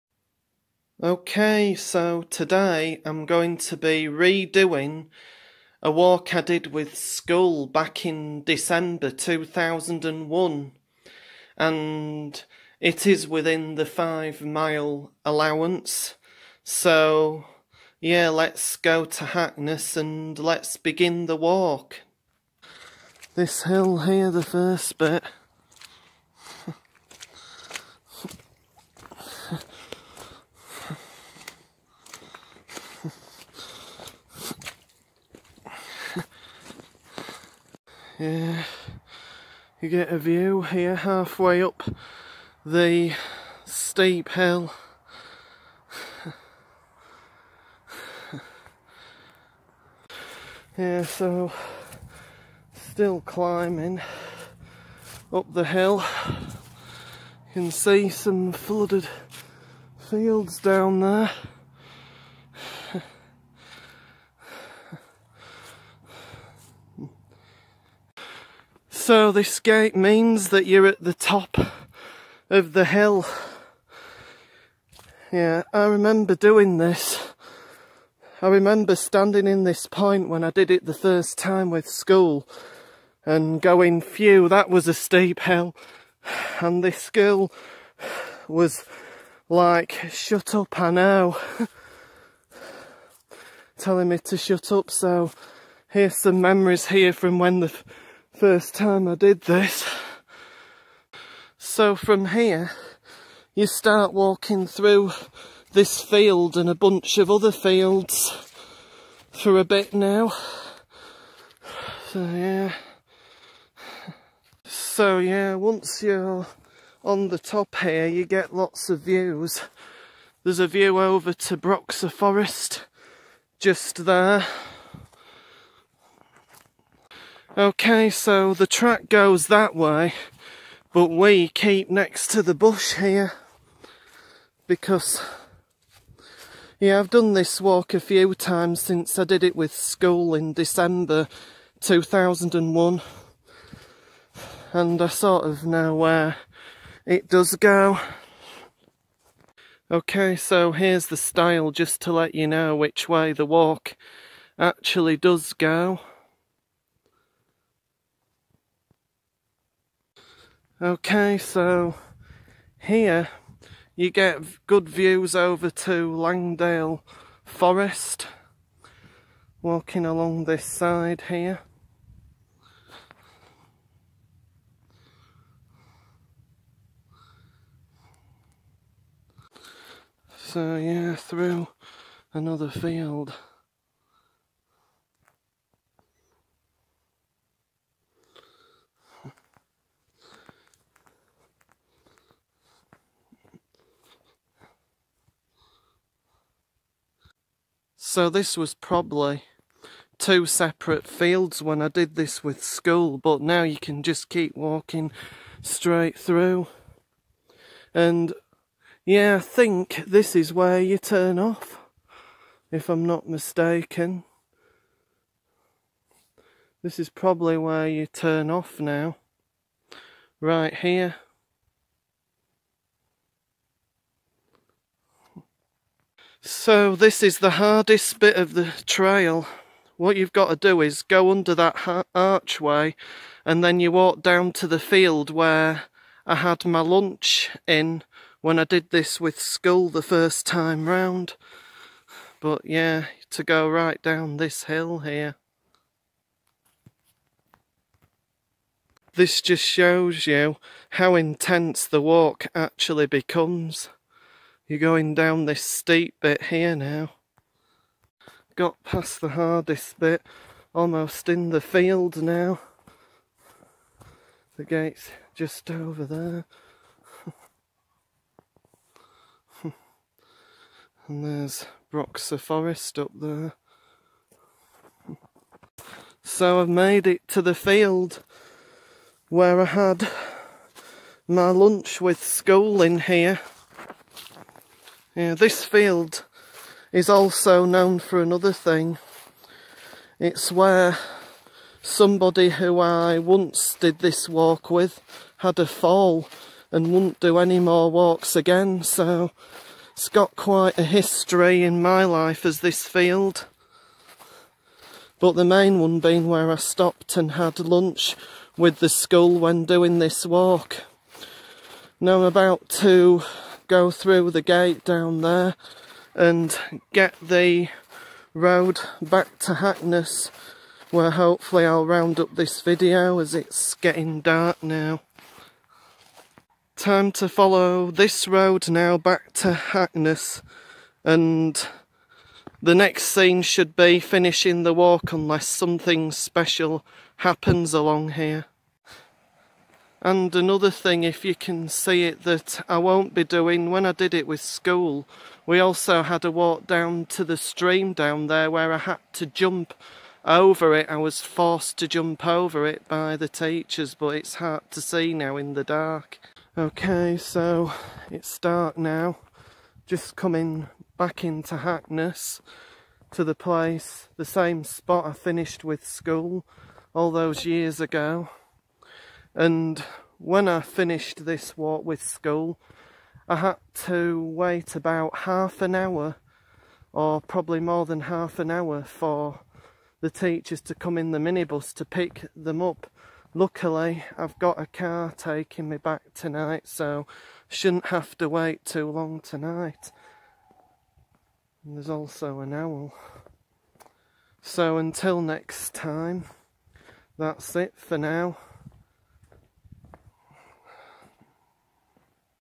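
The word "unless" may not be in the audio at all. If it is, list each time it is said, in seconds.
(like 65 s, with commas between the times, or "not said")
335 s.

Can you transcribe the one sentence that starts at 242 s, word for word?
But yeah, to go right down this hill here.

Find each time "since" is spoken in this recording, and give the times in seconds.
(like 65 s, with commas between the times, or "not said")
138 s.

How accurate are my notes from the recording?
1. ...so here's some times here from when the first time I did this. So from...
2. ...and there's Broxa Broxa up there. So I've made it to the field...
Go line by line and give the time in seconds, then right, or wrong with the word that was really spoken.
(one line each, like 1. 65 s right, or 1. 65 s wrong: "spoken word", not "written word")
1. 94 s wrong: "memories", not "times"
2. 271 s wrong: "Forest", not "Broxa".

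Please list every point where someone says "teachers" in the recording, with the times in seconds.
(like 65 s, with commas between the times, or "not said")
353 s, 380 s.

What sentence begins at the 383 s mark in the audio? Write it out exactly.
Luckily, I've got a car taking me back tonight, so shouldn't have to wait too long tonight.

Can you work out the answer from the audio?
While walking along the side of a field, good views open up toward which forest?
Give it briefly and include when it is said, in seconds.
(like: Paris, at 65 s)
Langdale Forest, at 166 s.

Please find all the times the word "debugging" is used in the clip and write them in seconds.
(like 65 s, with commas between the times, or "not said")
not said.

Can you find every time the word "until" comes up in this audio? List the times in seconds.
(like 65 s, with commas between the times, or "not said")
394 s.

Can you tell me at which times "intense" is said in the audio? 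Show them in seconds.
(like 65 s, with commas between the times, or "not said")
251 s.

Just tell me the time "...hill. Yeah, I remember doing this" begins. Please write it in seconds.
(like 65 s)
72 s.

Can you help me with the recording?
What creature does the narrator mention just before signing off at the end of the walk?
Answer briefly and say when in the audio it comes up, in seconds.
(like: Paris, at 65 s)
an owl, at 392 s.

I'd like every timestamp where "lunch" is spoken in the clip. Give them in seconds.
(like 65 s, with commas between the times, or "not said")
236 s, 281 s, 307 s.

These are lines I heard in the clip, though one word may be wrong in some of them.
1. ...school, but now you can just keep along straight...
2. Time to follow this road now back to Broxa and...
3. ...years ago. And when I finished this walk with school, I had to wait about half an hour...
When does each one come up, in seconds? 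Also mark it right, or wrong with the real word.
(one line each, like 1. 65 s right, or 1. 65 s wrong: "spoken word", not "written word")
1. 202 s wrong: "walking", not "along"
2. 326 s wrong: "Hackness", not "Broxa"
3. 367 s right.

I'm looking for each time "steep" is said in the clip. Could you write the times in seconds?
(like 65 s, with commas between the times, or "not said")
43 s, 84 s, 255 s.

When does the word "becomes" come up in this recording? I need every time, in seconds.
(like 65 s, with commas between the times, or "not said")
253 s.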